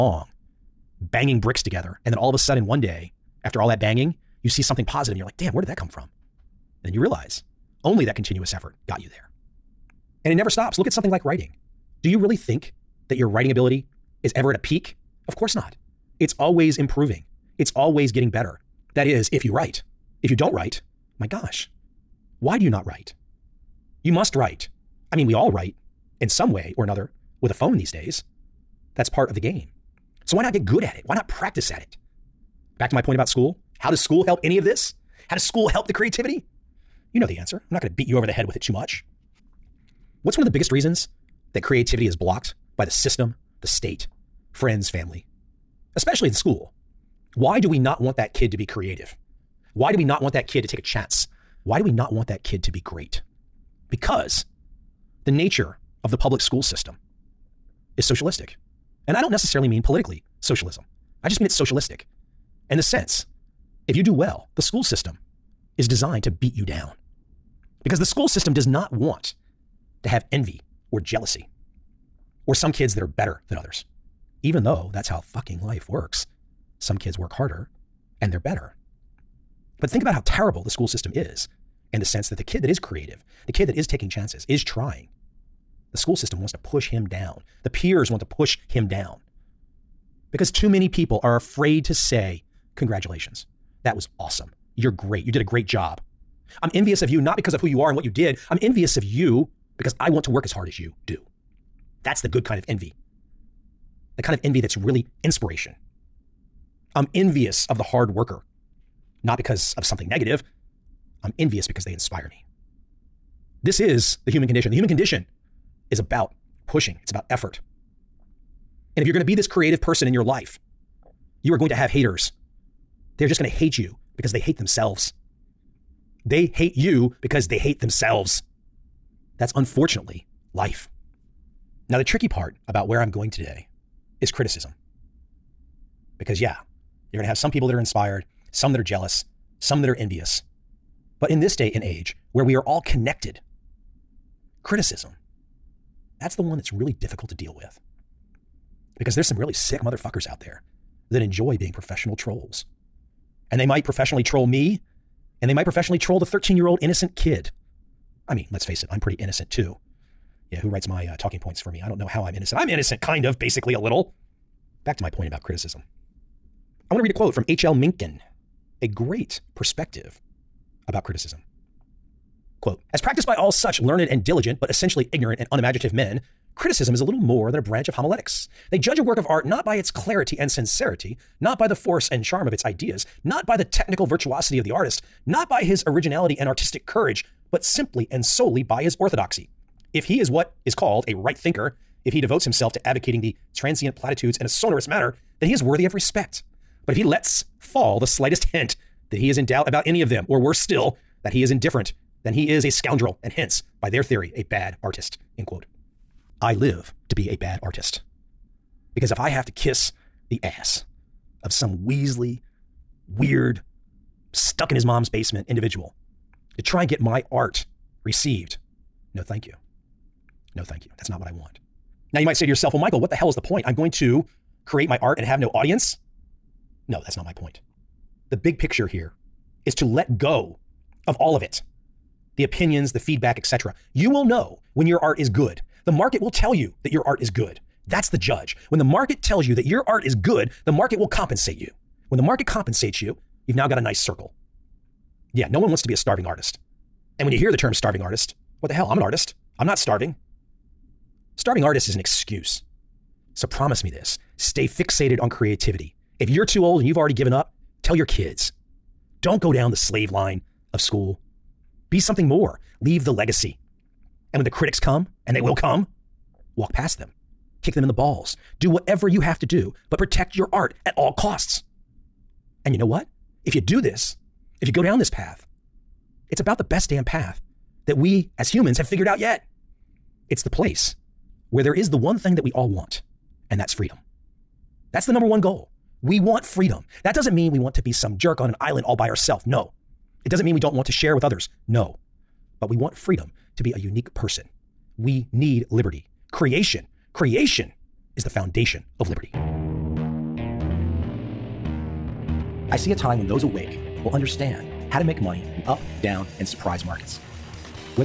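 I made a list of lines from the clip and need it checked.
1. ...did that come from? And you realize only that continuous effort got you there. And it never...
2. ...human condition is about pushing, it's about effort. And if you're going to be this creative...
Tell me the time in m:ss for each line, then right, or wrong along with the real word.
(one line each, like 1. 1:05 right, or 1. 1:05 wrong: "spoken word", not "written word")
1. 0:05 right
2. 1:54 right.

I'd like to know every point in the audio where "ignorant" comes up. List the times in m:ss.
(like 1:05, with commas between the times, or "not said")
2:55.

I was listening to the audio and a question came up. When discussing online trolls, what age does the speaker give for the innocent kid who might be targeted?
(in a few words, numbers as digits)
13.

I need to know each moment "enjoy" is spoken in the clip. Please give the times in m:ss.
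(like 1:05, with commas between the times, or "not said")
2:31.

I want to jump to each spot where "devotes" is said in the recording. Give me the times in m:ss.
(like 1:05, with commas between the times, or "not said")
3:12.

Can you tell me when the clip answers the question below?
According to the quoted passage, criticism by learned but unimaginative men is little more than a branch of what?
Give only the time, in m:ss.
2:57.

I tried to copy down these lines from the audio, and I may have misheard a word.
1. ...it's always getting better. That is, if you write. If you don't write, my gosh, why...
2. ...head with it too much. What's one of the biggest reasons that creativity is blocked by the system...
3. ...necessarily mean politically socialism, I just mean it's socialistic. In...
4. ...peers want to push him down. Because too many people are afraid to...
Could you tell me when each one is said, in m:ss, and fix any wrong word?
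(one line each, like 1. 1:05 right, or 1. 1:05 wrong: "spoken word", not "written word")
1. 0:17 right
2. 0:38 right
3. 0:59 right
4. 1:27 right.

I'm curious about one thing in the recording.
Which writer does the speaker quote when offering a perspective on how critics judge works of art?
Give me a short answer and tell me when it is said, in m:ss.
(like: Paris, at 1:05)
H.L. Mencken, at 2:47.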